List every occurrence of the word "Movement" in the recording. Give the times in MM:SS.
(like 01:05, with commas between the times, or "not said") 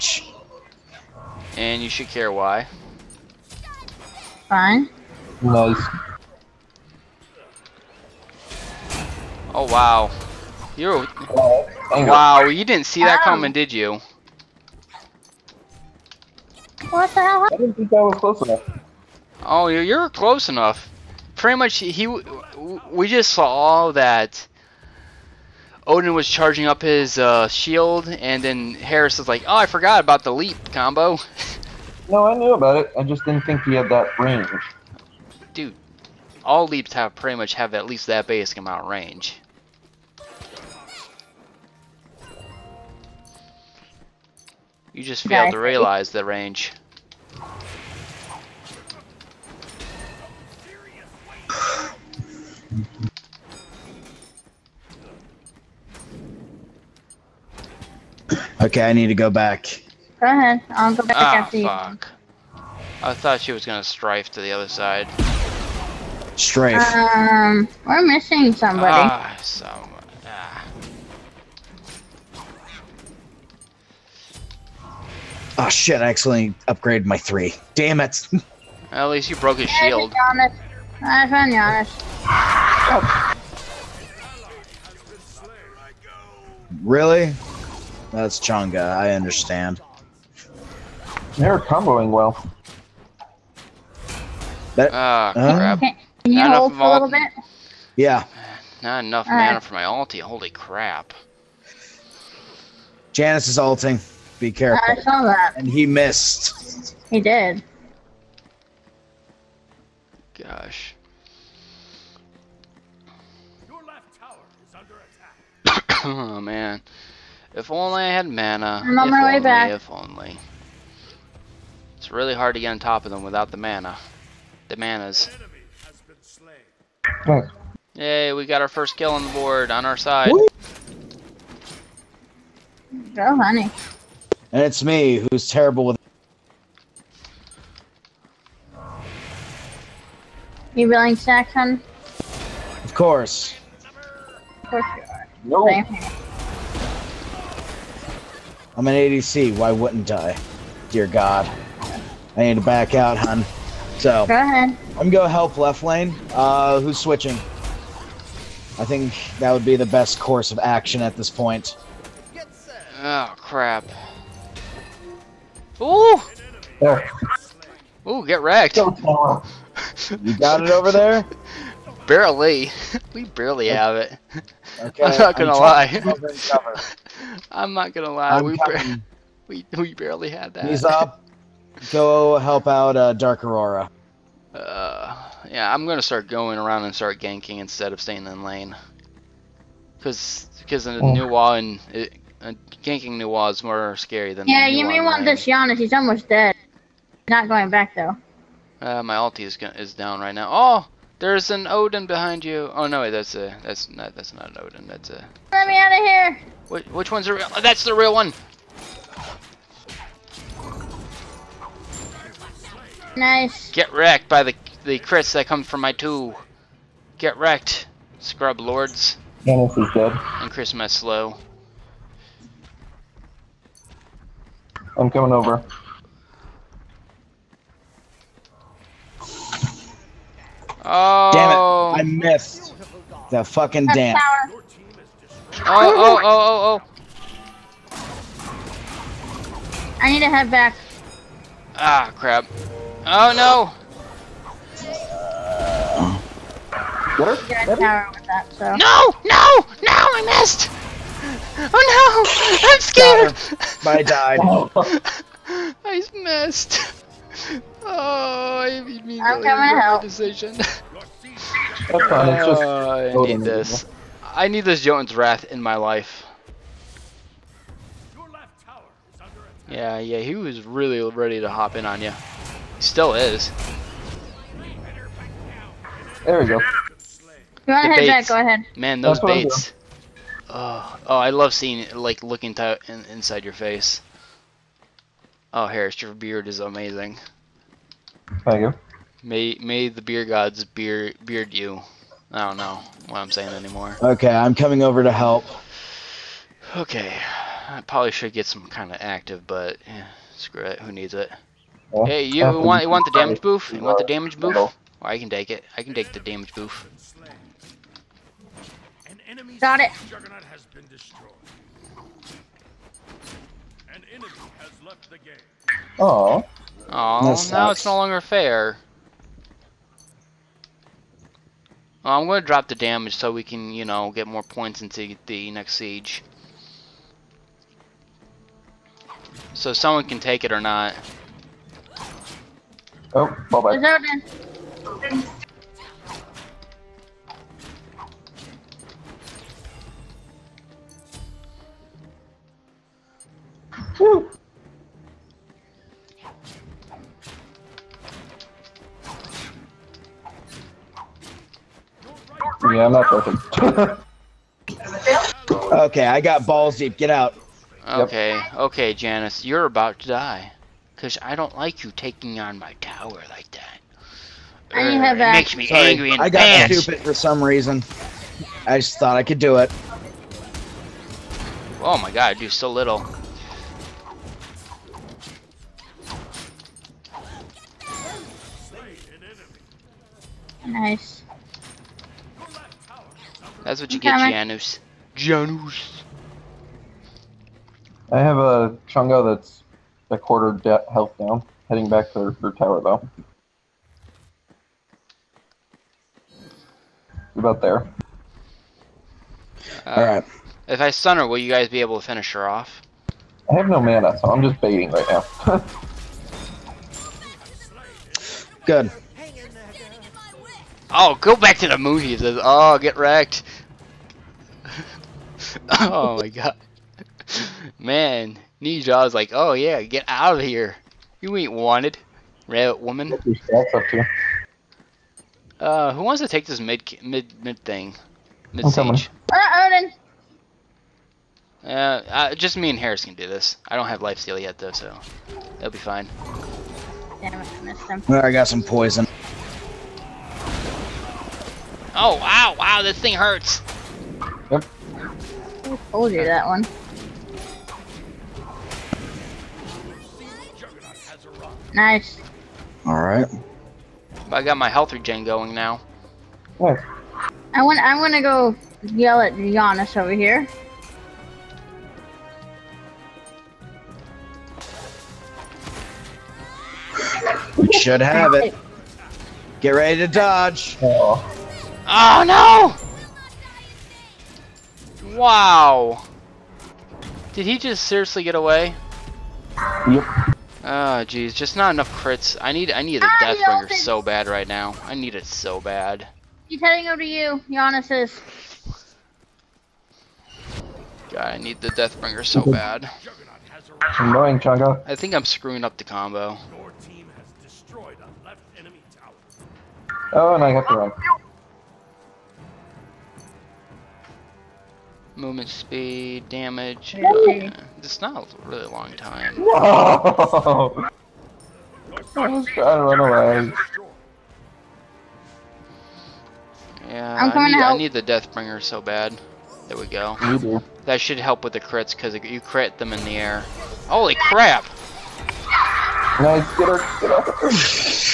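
08:25.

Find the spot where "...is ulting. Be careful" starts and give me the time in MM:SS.
01:43.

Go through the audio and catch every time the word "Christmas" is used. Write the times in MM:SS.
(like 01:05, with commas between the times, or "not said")
03:40.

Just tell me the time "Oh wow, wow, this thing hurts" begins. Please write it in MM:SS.
07:21.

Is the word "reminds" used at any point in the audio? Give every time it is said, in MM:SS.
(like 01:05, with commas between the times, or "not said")
not said.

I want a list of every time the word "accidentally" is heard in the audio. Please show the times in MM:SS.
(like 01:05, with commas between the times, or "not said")
01:16.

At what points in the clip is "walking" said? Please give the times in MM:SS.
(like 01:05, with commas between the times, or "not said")
not said.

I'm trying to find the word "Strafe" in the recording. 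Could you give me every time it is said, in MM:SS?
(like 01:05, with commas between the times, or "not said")
01:06.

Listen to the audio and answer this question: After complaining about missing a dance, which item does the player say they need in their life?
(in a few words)
Jotun's Wrath.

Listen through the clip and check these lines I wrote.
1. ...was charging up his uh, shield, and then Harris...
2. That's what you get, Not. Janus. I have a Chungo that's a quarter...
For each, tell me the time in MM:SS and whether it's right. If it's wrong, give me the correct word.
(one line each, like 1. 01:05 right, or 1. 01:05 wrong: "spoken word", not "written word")
1. 00:26 right
2. 06:23 wrong: "Janus", not "Not".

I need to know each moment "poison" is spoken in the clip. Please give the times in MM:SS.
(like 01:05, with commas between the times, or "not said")
07:18.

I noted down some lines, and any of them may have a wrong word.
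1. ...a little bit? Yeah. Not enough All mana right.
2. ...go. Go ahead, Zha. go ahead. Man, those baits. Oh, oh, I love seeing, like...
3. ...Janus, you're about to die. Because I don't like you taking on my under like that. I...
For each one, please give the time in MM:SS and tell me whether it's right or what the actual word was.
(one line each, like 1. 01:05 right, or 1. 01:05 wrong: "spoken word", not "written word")
1. 01:36 right
2. 04:36 wrong: "Jack", not "Zha"
3. 05:58 wrong: "tower", not "under".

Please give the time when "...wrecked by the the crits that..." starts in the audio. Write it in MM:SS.
03:33.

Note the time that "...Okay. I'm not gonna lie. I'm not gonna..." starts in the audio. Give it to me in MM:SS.
02:54.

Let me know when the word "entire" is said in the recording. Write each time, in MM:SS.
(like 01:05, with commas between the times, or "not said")
not said.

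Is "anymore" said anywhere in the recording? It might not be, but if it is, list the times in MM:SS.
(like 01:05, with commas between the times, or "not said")
04:53.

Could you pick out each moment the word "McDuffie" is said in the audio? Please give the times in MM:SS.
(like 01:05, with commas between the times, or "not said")
not said.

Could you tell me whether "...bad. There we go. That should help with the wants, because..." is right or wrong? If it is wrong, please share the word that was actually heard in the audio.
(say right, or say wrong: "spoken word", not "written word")
wrong: "crits", not "wants".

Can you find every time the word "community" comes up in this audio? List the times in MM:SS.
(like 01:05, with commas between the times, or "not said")
not said.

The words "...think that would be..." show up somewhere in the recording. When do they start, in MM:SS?
02:38.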